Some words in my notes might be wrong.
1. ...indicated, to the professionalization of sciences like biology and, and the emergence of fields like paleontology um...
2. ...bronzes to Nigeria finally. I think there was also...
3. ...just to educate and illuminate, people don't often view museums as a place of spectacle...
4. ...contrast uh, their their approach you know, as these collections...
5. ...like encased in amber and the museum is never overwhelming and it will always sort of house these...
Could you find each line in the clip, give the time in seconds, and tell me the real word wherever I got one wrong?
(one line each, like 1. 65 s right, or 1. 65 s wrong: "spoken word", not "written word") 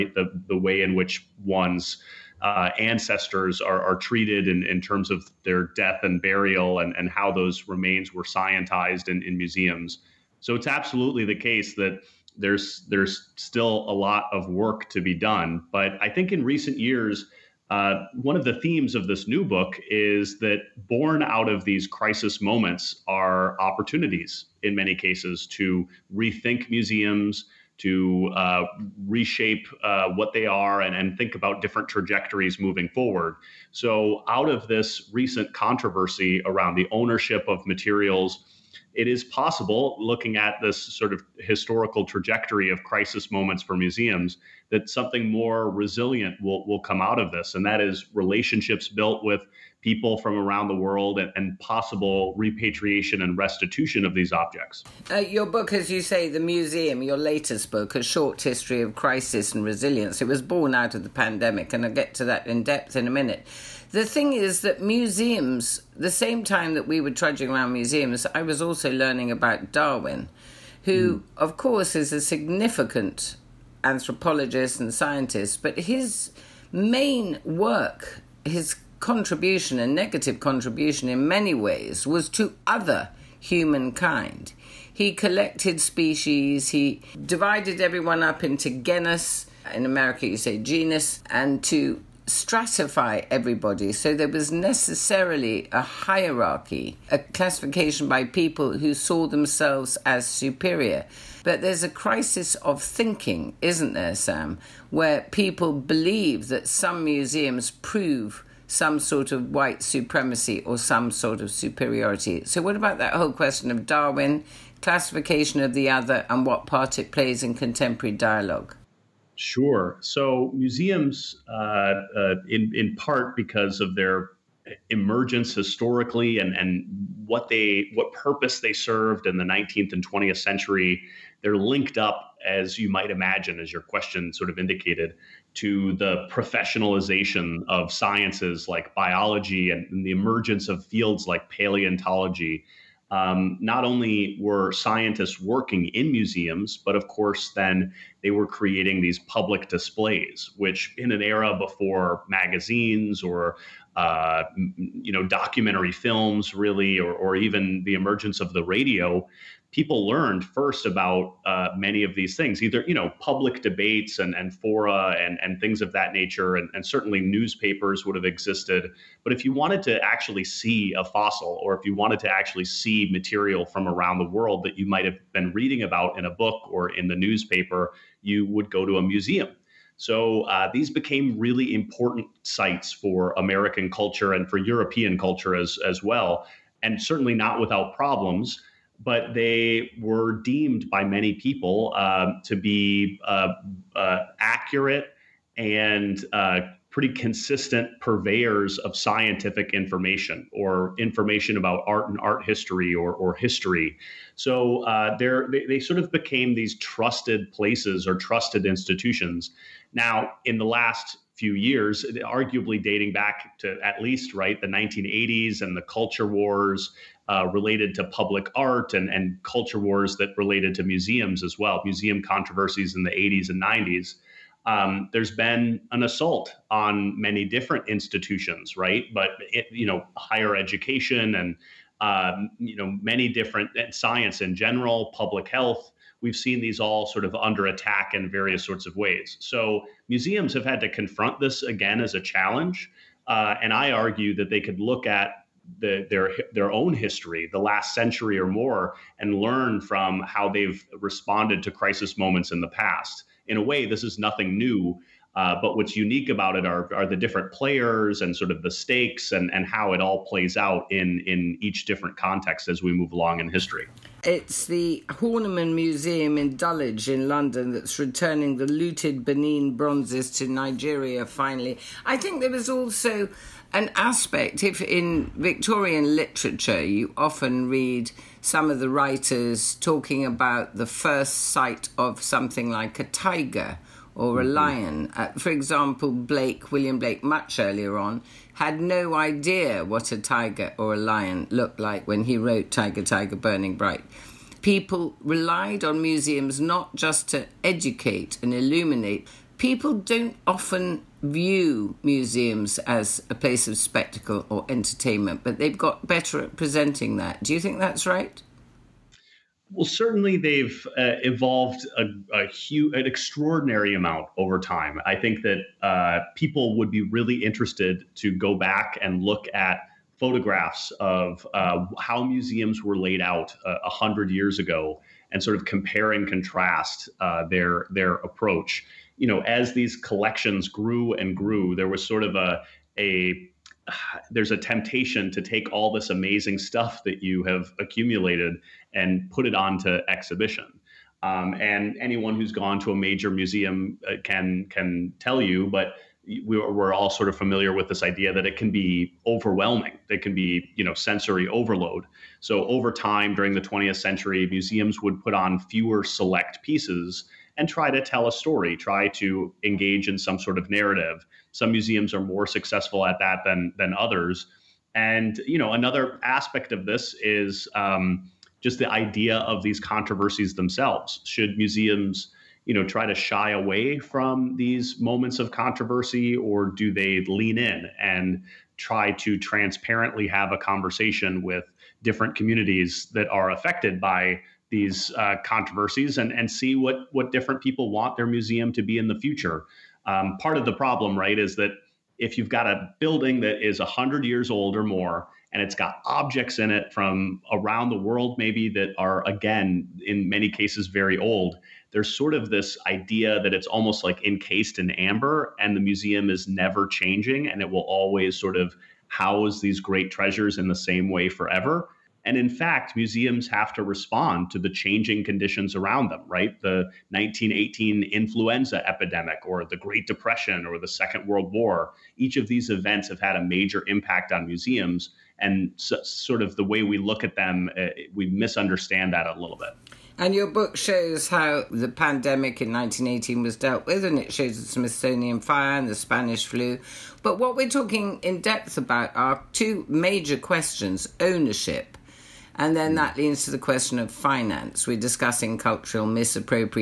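1. 134 s right
2. 269 s right
3. 296 s right
4. 326 s right
5. 404 s wrong: "changing", not "overwhelming".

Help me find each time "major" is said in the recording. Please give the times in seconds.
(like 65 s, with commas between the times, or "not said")
342 s, 423 s, 439 s.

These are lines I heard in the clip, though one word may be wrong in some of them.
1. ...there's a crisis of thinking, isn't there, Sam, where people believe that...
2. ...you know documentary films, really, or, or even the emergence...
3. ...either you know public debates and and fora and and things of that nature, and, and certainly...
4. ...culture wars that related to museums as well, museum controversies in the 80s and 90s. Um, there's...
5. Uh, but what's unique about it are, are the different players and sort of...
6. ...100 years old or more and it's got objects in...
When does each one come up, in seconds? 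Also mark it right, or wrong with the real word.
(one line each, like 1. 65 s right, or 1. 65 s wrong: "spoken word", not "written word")
1. 101 s right
2. 154 s right
3. 162 s right
4. 219 s right
5. 255 s right
6. 393 s right.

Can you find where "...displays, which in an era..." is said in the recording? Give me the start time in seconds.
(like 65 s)
149 s.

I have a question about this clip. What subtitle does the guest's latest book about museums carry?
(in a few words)
A Short History of Crisis and Resilience.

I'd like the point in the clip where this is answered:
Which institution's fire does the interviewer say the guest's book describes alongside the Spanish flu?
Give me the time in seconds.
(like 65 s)
434 s.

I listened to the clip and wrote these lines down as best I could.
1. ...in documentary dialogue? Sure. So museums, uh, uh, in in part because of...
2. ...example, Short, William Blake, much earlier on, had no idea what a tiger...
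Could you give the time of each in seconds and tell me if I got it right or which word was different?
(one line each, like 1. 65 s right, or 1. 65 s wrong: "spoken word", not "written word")
1. 117 s wrong: "contemporary", not "documentary"
2. 285 s wrong: "Blake", not "Short".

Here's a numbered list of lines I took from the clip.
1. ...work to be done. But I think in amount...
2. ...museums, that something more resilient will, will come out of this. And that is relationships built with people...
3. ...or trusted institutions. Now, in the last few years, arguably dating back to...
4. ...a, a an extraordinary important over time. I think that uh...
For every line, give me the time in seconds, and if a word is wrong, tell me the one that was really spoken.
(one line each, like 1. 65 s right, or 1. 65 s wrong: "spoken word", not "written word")
1. 14 s wrong: "recent", not "amount"
2. 43 s right
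3. 208 s right
4. 311 s wrong: "amount", not "important".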